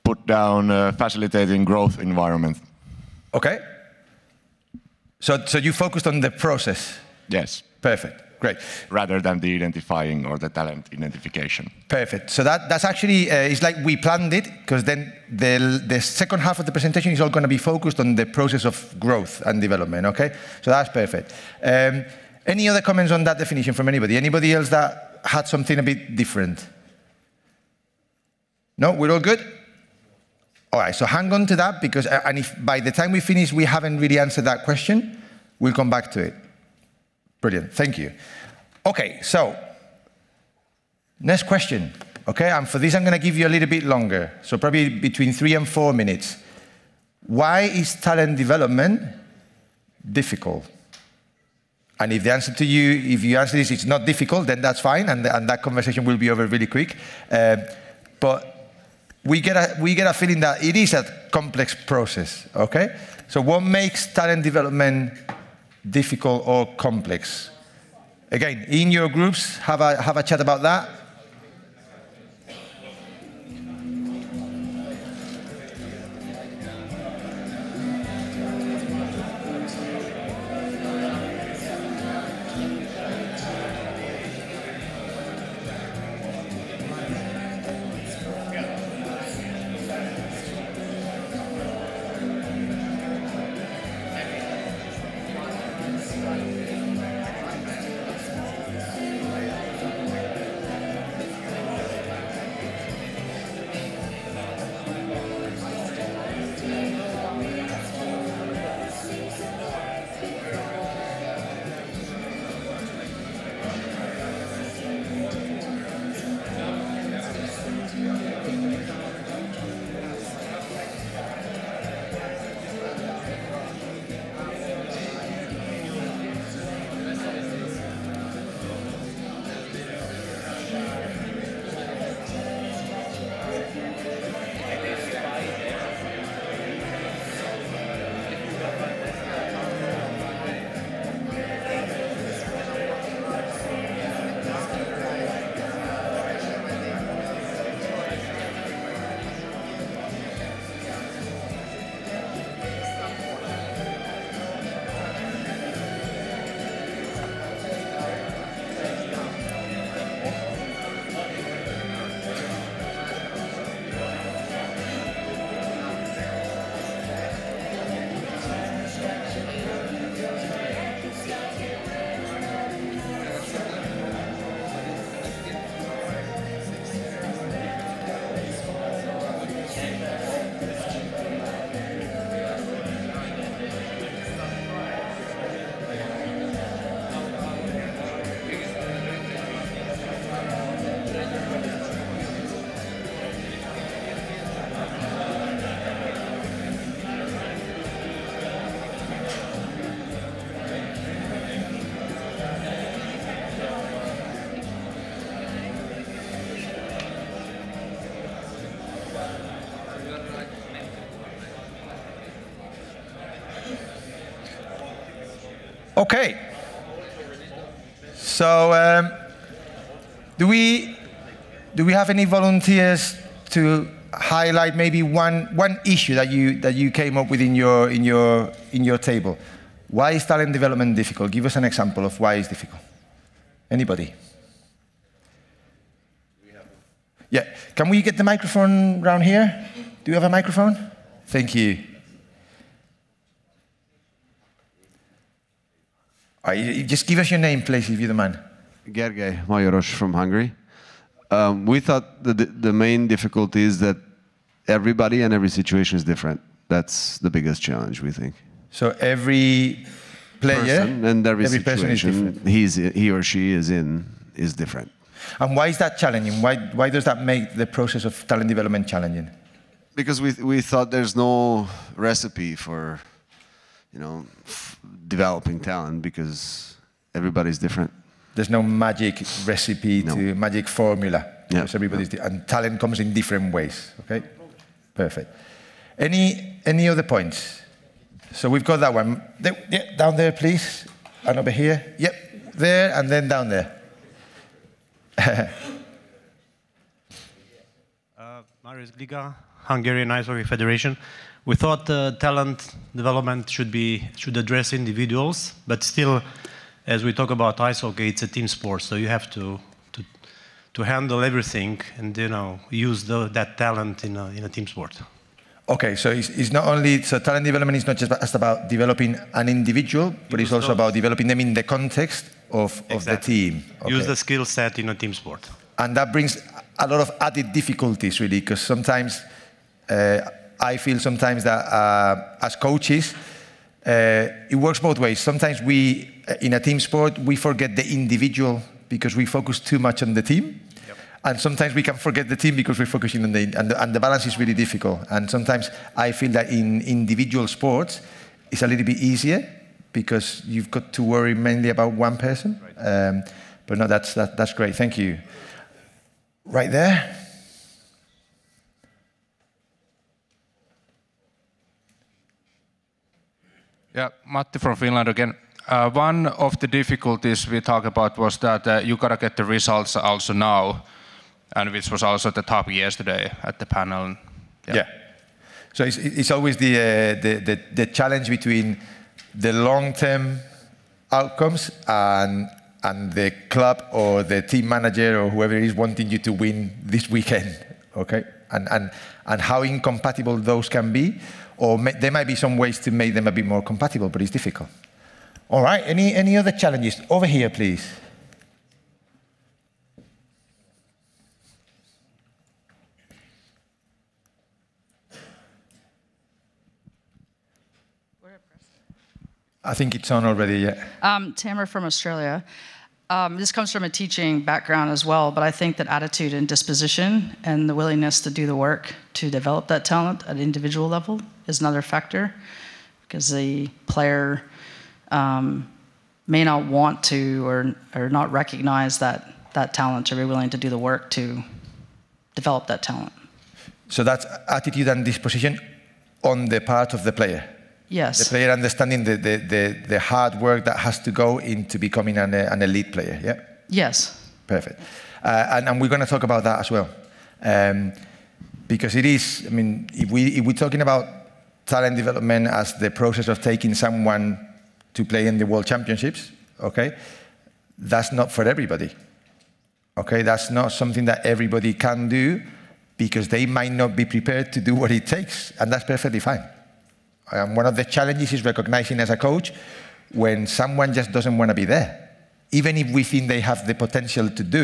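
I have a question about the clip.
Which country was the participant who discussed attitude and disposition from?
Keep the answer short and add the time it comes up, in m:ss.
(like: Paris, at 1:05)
Australia, at 6:51.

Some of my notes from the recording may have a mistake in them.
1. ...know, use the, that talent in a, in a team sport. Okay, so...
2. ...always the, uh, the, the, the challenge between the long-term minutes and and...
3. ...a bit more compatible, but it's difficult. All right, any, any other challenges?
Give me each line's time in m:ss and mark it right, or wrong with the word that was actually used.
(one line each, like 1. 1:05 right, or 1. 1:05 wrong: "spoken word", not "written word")
1. 5:12 right
2. 6:16 wrong: "outcomes", not "minutes"
3. 6:33 right.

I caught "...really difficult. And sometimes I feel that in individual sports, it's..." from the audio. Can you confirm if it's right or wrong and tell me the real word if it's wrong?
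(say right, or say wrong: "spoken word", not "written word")
right.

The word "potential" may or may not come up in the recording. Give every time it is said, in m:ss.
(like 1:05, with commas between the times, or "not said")
7:53.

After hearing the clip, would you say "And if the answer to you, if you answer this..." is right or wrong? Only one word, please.
right.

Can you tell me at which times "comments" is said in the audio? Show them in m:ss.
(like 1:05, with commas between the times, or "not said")
0:22.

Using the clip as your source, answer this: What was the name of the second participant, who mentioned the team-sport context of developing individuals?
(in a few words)
Marius Gliga.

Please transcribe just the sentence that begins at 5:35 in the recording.
Sometimes we, uh, in a team sport, we forget the individual because we focus too much on the team.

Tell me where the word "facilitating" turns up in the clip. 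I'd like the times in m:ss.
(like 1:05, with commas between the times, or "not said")
0:00.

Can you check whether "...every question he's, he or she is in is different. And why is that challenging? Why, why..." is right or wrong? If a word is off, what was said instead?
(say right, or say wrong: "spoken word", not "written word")
wrong: "situation", not "question".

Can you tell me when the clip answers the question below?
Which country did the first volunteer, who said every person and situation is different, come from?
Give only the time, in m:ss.
4:10.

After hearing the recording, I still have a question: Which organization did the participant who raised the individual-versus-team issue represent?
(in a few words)
Hungarian Ice Hockey Federation.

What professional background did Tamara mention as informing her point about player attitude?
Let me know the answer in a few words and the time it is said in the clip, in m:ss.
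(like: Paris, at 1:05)
teaching, at 6:53.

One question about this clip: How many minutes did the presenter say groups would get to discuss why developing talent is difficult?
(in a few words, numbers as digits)
3 to 4 minutes.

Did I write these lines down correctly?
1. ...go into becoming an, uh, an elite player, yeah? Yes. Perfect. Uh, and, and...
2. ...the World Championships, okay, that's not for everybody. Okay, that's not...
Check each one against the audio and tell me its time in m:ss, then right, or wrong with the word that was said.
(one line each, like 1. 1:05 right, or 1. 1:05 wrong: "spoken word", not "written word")
1. 7:21 right
2. 7:35 right.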